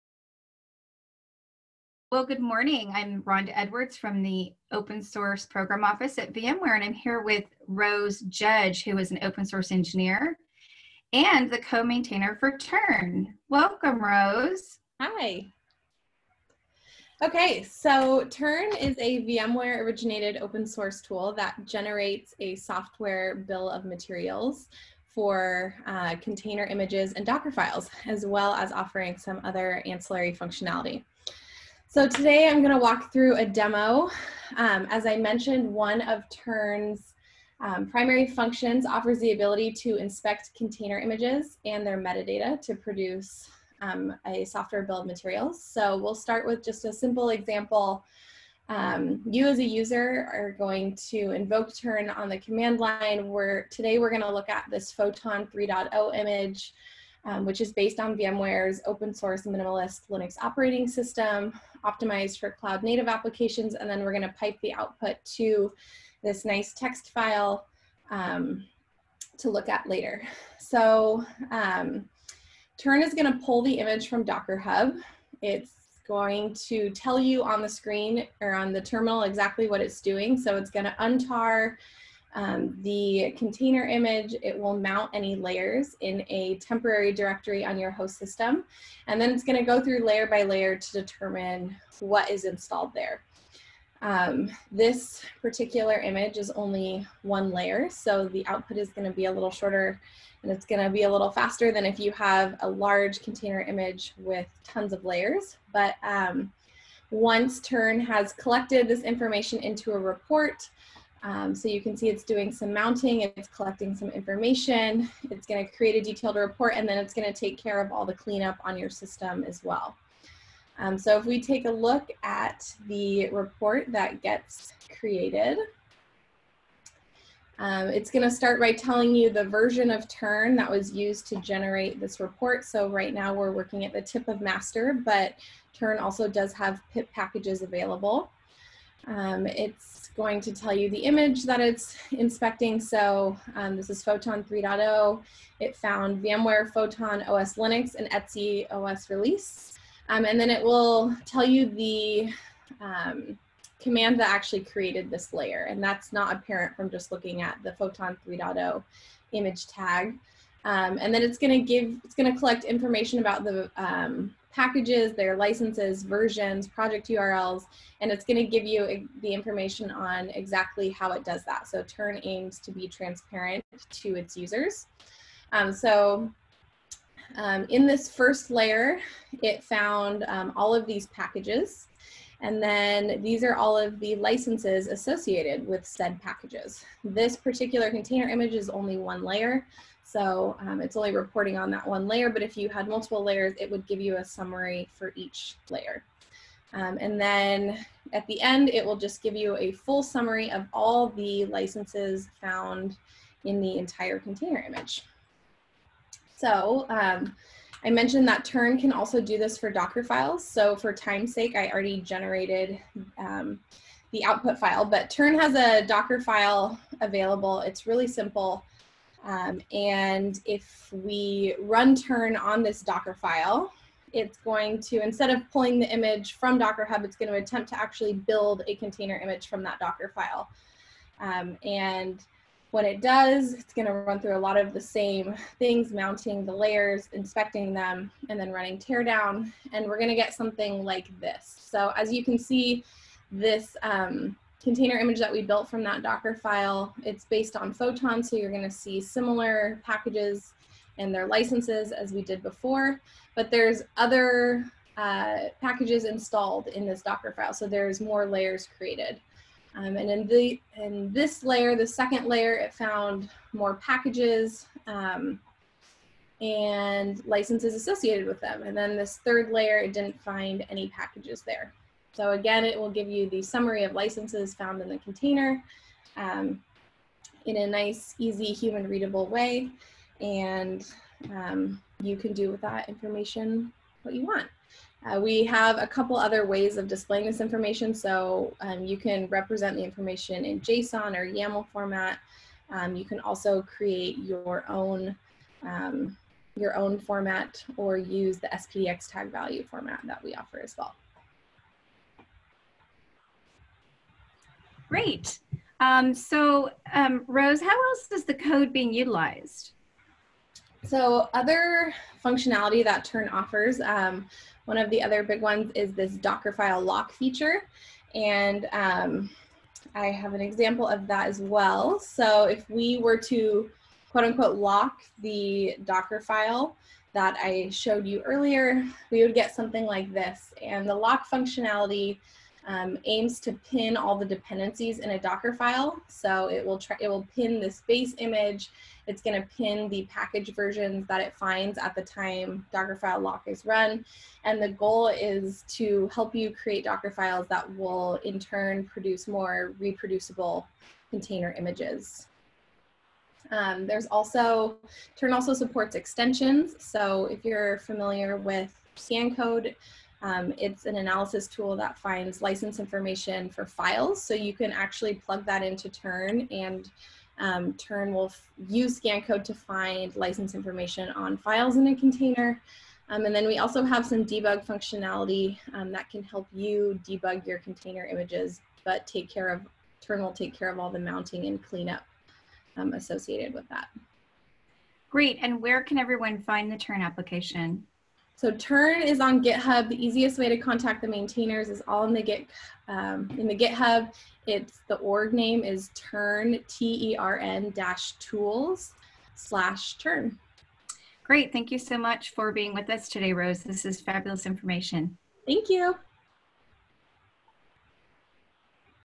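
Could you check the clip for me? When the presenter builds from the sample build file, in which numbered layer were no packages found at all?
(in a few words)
third layer.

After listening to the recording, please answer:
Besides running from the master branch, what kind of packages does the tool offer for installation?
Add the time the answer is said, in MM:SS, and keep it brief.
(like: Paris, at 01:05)
PIP packages, at 02:16.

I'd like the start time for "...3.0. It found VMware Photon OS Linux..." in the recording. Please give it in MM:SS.
02:24.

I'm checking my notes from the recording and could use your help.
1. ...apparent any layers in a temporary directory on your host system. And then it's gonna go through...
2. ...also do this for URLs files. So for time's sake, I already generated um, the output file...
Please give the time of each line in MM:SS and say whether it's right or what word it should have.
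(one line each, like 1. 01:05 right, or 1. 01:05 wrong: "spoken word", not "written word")
1. 01:24 wrong: "mount", not "apparent"
2. 03:28 wrong: "Docker", not "URLs".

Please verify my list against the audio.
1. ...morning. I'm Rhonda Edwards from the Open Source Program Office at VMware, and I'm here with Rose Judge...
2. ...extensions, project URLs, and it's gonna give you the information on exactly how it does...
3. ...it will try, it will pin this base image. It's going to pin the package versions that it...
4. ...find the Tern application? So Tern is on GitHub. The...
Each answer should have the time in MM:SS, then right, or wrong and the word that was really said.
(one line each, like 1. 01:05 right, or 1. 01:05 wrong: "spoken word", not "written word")
1. 00:02 right
2. 02:46 wrong: "versions", not "extensions"
3. 05:36 right
4. 06:26 right.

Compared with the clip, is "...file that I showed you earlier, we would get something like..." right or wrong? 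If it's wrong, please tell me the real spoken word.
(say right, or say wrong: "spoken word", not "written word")
right.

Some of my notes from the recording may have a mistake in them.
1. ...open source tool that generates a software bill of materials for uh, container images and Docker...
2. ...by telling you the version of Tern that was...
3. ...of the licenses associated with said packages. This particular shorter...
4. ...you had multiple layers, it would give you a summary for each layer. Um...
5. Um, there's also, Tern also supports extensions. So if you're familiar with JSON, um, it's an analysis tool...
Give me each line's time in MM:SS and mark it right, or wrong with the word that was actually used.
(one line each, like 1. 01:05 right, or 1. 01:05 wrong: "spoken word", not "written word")
1. 00:20 right
2. 02:08 right
3. 03:03 wrong: "container", not "shorter"
4. 03:12 right
5. 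05:53 wrong: "ScanCode", not "JSON".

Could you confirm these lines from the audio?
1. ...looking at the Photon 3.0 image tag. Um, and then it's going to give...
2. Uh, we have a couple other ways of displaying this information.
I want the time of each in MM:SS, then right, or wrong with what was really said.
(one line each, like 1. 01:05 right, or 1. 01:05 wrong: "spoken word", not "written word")
1. 02:37 right
2. 04:45 right.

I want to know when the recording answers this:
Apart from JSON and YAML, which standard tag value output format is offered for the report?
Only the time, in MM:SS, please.
04:58.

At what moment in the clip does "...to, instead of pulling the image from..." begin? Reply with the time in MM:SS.
03:44.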